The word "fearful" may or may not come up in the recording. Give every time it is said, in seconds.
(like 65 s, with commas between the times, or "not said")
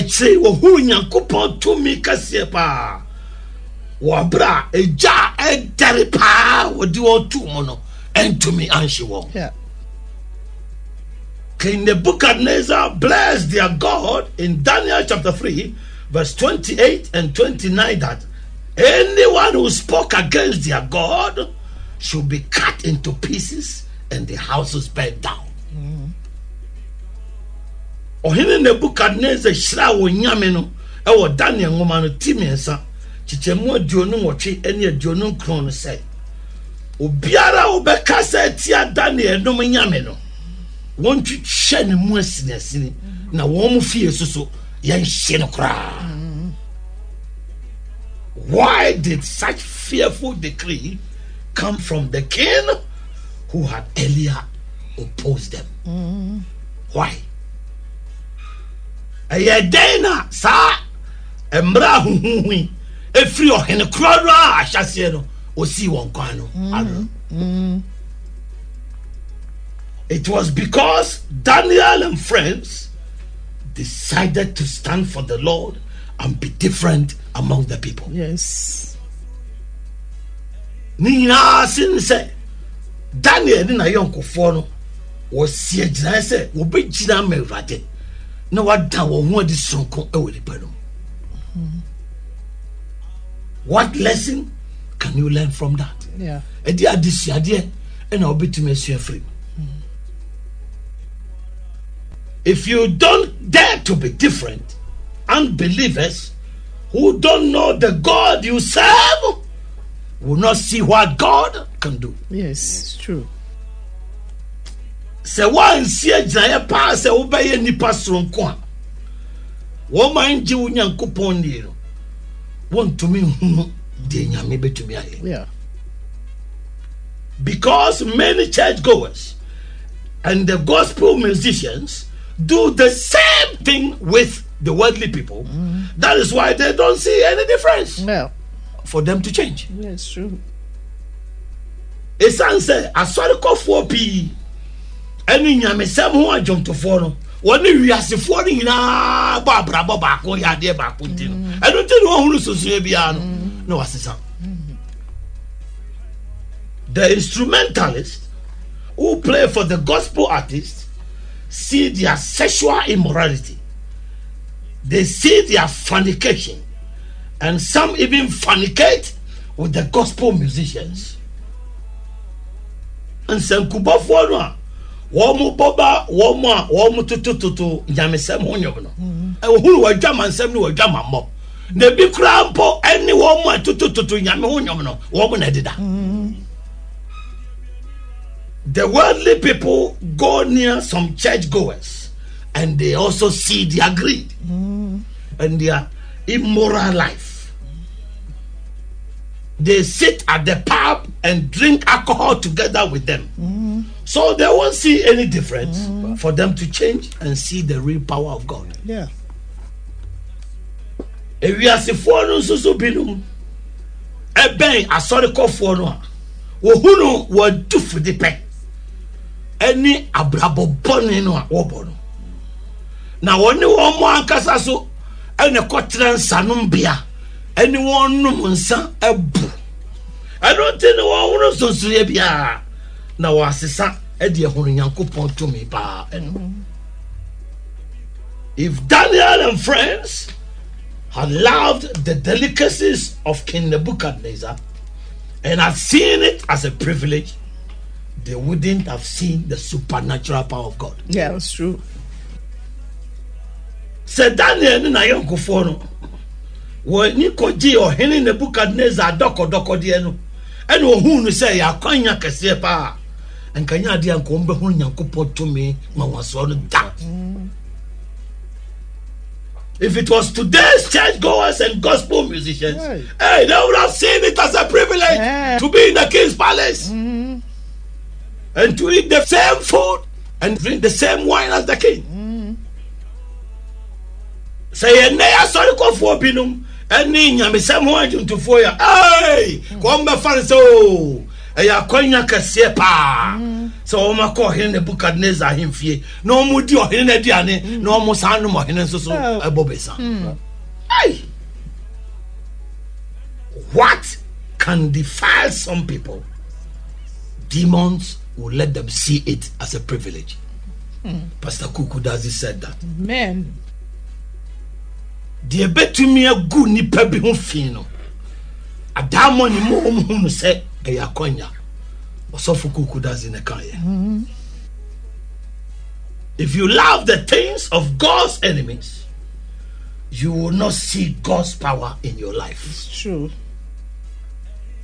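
49 s.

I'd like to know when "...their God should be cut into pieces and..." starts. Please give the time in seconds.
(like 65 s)
20 s.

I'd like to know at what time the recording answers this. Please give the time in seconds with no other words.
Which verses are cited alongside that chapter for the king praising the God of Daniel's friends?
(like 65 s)
16 s.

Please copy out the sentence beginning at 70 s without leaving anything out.
It was because Daniel and friends decided to stand for the Lord and be different among the people.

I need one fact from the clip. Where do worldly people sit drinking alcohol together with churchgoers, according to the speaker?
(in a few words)
The pub.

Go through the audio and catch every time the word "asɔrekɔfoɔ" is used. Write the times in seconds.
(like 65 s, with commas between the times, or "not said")
142 s, 214 s.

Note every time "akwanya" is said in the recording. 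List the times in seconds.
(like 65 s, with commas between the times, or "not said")
261 s, 291 s.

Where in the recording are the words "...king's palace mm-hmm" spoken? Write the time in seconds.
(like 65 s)
276 s.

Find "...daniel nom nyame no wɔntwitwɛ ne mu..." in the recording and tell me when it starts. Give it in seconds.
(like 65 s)
38 s.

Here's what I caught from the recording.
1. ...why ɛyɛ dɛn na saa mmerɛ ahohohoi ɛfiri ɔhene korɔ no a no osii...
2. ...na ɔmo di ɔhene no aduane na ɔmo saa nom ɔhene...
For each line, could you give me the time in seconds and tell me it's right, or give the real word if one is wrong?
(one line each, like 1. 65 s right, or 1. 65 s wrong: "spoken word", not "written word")
1. 56 s right
2. 296 s right.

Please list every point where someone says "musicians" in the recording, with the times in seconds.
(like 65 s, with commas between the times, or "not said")
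131 s, 170 s, 272 s.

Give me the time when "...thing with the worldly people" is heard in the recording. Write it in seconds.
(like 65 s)
133 s.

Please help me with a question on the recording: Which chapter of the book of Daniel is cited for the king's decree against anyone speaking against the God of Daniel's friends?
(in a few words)
Chapter 3.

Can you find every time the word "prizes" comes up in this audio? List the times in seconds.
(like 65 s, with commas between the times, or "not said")
not said.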